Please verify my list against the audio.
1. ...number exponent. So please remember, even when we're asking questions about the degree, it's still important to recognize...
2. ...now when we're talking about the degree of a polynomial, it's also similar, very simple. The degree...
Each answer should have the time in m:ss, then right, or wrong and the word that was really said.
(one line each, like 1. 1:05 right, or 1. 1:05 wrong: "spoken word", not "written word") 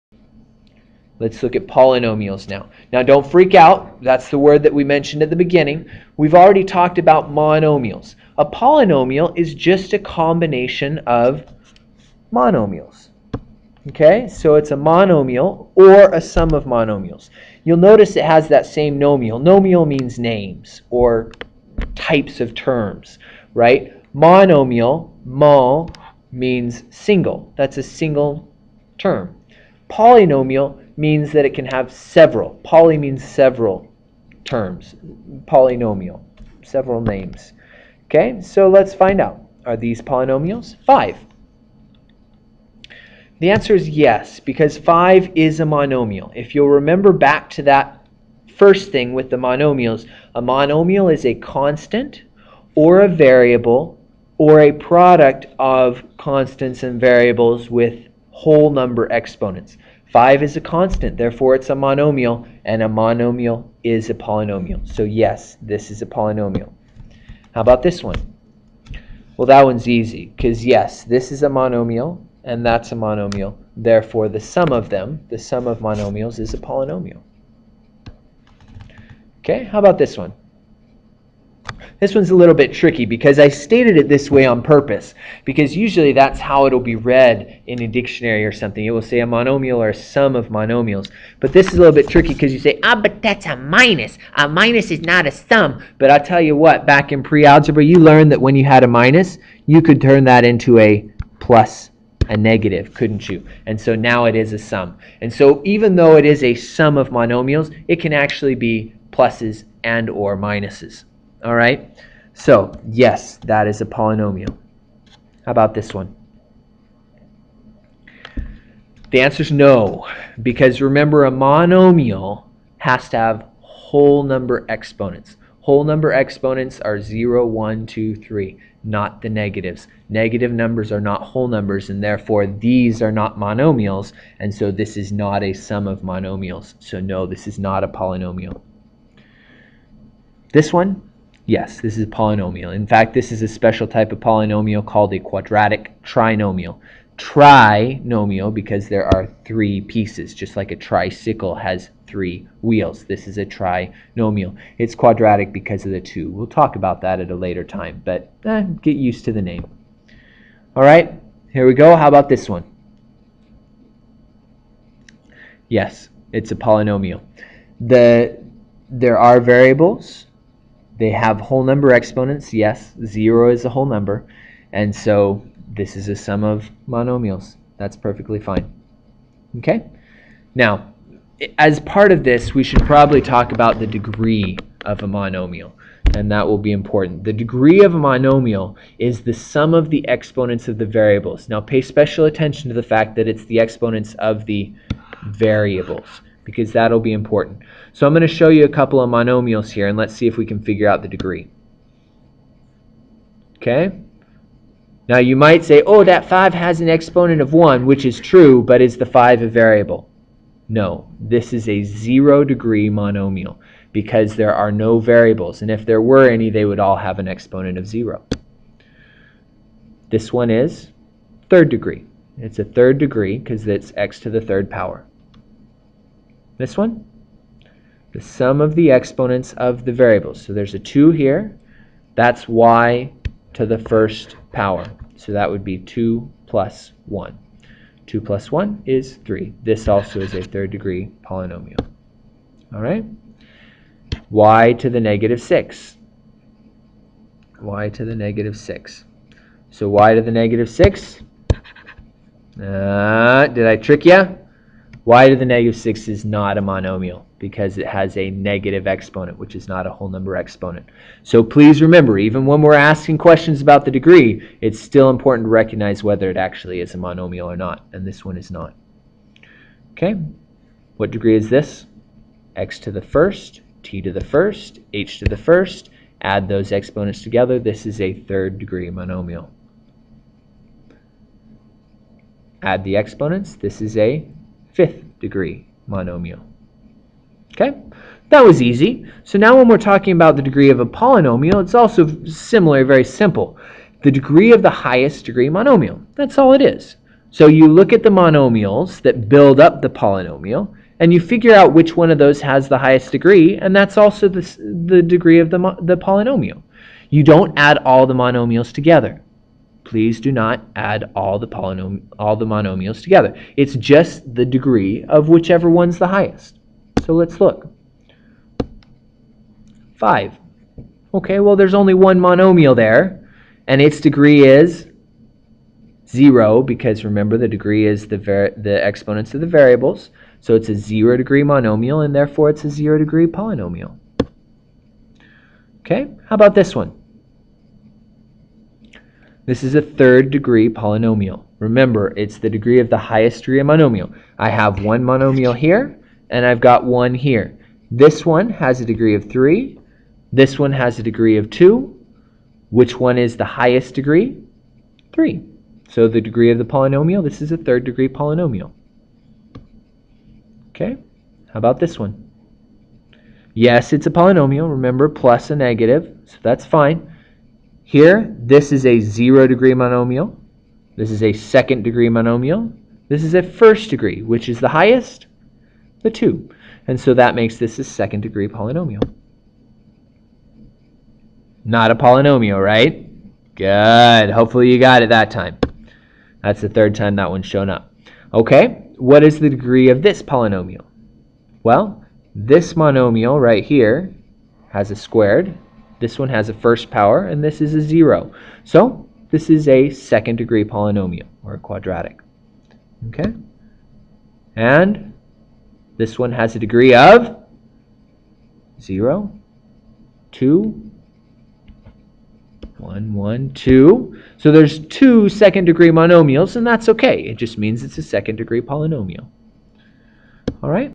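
1. 4:20 right
2. 4:49 right.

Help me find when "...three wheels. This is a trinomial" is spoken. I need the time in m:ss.
2:32.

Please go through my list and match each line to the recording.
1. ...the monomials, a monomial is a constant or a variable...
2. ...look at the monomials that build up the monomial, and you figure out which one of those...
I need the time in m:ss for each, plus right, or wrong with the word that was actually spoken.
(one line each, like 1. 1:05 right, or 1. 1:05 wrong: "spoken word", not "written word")
1. 0:49 right
2. 4:57 wrong: "polynomial", not "monomial".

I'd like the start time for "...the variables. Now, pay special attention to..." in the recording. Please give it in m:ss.
3:10.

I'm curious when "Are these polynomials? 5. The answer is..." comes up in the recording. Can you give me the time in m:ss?
0:39.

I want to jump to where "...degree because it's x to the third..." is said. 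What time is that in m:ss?
3:42.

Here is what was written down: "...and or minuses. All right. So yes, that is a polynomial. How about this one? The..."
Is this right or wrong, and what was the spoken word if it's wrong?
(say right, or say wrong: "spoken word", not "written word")
right.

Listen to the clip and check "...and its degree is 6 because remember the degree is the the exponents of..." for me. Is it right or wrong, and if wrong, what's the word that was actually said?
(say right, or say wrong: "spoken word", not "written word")
wrong: "0", not "6".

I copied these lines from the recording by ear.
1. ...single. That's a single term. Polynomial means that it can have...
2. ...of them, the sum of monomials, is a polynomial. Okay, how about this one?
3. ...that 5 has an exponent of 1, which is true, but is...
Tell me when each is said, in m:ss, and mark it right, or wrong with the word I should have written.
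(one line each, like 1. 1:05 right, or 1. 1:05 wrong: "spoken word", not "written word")
1. 0:26 right
2. 1:14 right
3. 3:26 right.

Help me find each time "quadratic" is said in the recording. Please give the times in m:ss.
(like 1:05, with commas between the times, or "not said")
2:25, 2:34, 6:41.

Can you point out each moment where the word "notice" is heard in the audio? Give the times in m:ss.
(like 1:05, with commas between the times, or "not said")
0:17.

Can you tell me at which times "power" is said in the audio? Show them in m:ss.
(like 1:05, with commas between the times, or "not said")
3:44, 3:54, 6:36.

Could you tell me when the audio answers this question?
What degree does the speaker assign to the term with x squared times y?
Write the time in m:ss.
3:58.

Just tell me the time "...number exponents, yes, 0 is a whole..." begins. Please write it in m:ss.
2:51.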